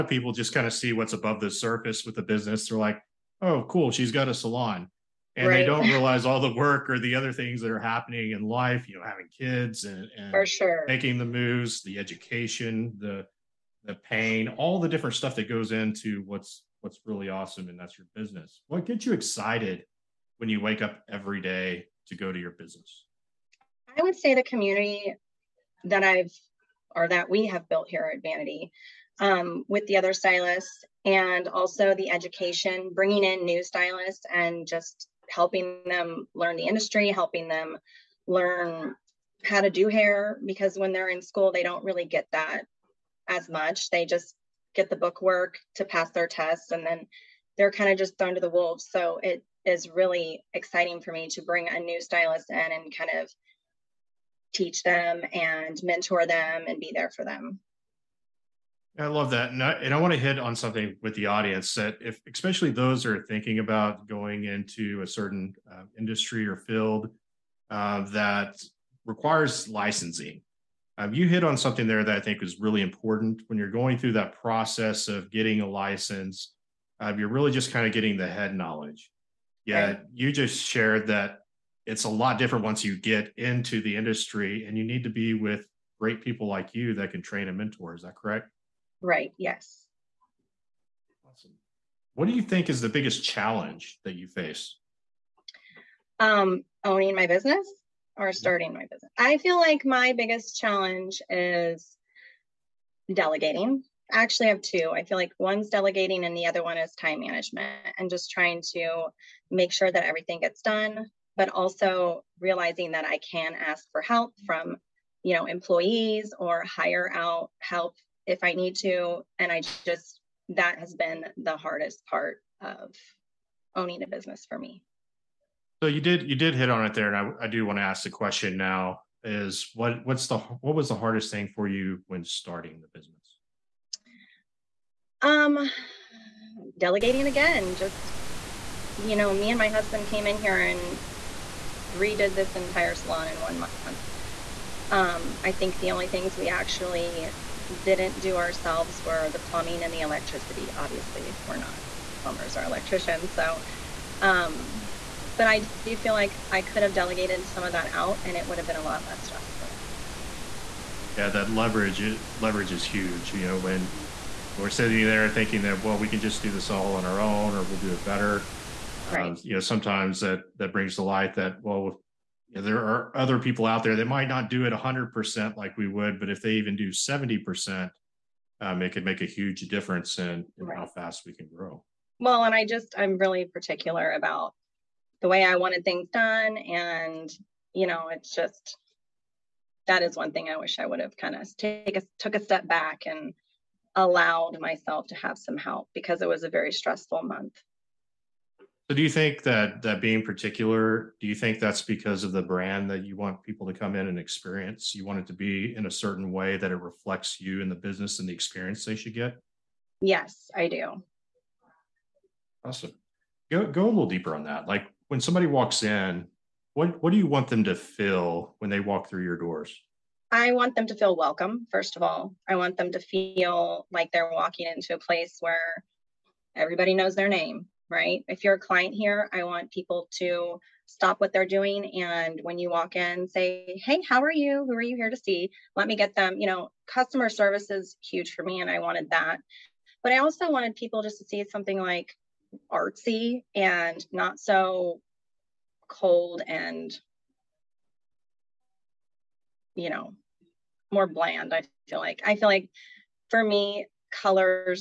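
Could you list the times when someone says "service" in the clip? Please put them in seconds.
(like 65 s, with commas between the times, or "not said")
237 s.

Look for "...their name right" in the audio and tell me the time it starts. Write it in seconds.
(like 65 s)
227 s.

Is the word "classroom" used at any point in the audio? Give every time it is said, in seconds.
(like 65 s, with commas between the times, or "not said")
not said.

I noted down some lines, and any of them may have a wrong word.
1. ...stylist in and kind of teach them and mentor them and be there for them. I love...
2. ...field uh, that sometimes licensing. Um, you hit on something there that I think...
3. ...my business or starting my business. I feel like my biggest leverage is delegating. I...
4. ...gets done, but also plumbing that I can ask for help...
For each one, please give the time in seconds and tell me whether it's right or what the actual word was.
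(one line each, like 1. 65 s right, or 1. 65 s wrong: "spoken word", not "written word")
1. 52 s right
2. 66 s wrong: "requires", not "sometimes"
3. 97 s wrong: "challenge", not "leverage"
4. 110 s wrong: "realizing", not "plumbing".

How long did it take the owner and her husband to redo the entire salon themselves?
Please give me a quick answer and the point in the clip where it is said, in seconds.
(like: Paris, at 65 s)
one month, at 143 s.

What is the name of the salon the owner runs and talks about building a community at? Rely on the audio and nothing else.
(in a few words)
Vanity.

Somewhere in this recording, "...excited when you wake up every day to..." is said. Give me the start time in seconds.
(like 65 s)
19 s.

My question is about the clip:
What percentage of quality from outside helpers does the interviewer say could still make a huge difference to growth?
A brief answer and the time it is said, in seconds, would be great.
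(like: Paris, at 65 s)
70%, at 176 s.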